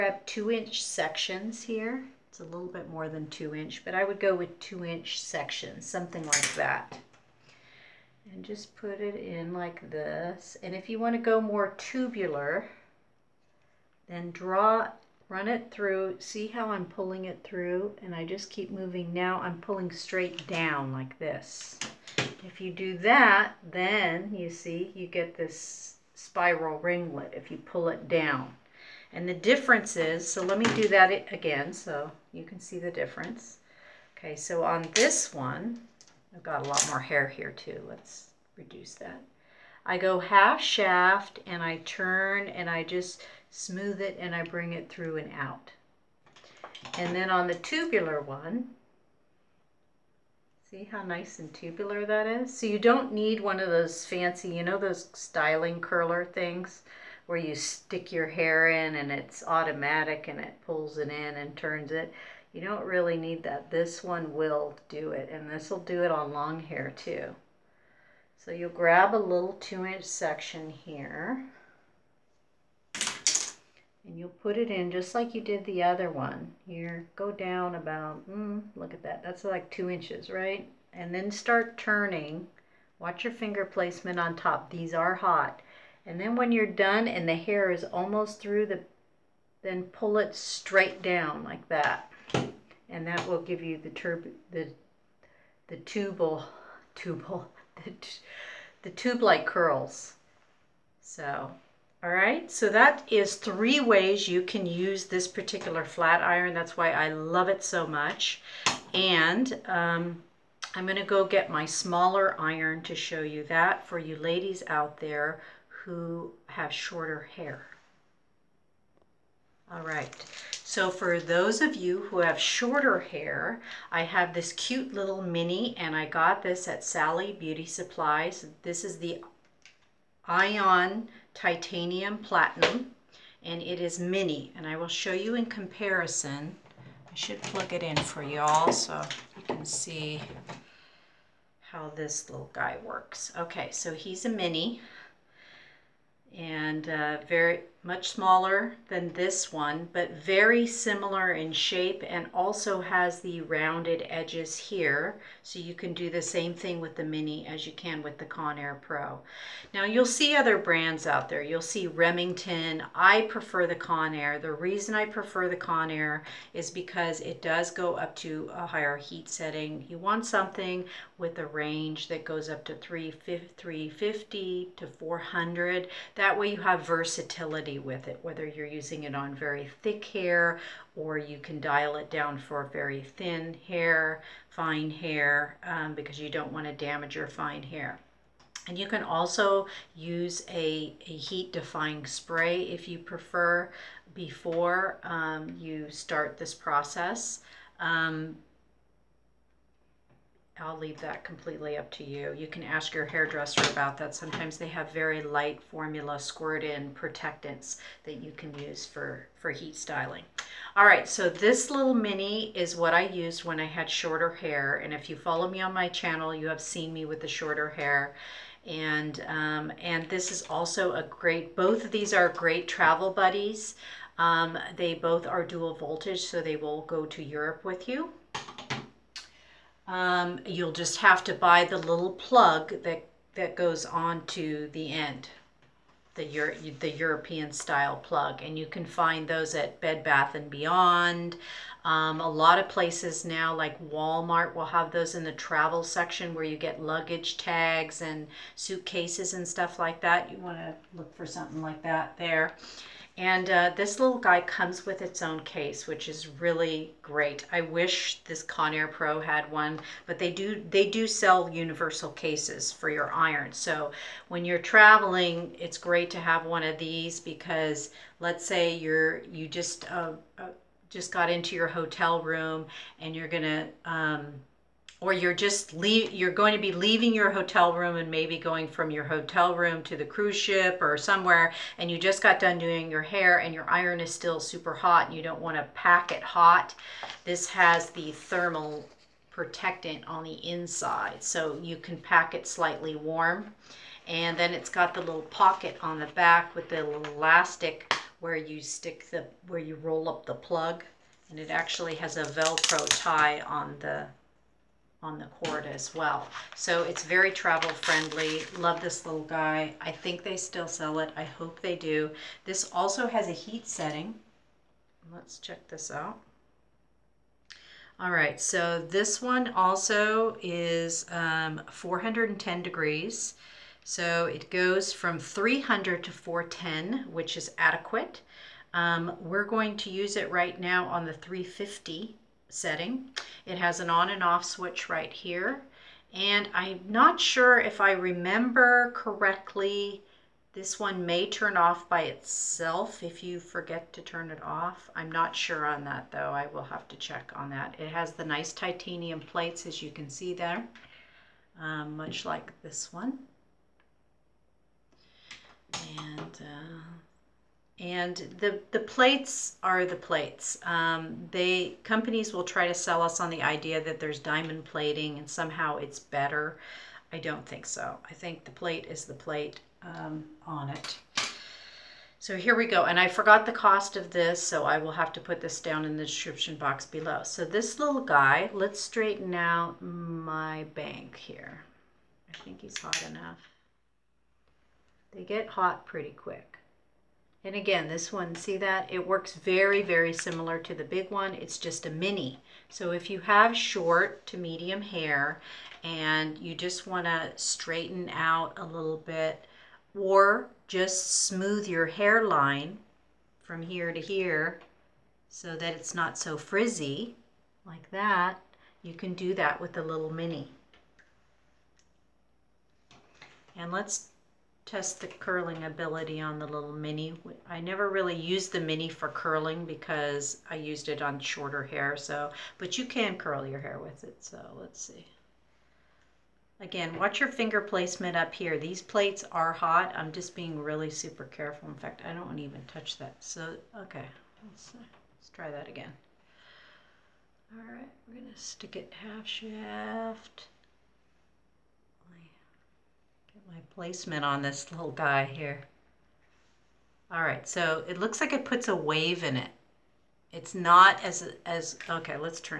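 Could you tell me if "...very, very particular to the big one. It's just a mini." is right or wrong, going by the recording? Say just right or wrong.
wrong.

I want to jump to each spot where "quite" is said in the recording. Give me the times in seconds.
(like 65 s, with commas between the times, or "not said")
not said.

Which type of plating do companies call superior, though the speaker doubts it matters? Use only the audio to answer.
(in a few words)
diamond plating.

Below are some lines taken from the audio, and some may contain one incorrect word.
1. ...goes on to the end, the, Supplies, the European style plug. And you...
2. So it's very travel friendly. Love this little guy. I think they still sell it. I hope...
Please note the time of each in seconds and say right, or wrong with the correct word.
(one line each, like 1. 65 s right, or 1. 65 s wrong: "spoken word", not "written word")
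1. 233 s wrong: "Euro", not "Supplies"
2. 306 s right.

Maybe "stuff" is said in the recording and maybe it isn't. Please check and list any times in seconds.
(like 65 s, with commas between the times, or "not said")
249 s.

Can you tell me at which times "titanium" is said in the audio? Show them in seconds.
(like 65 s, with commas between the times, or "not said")
131 s, 348 s.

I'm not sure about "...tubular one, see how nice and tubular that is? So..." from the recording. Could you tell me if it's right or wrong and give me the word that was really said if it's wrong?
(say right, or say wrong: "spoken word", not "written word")
right.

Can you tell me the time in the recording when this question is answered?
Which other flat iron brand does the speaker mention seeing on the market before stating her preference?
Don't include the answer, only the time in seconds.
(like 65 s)
161 s.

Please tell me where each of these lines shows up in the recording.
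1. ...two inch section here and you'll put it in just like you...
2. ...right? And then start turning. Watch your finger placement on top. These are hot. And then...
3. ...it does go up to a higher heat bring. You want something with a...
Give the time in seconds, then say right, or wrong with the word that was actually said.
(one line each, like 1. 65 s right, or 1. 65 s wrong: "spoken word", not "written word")
1. 69 s right
2. 80 s right
3. 167 s wrong: "setting", not "bring".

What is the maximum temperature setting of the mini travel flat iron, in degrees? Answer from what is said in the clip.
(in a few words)
410.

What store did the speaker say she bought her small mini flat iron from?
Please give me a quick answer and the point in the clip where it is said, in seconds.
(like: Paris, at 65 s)
Sally Beauty Supplies, at 126 s.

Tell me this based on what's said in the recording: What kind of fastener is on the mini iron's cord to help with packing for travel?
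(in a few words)
Velcro tie.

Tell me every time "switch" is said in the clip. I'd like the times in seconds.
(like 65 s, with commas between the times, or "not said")
334 s.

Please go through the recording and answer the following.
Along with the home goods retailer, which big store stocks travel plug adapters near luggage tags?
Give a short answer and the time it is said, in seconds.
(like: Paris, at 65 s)
Walmart, at 243 s.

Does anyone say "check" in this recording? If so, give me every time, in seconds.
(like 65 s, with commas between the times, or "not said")
315 s, 346 s.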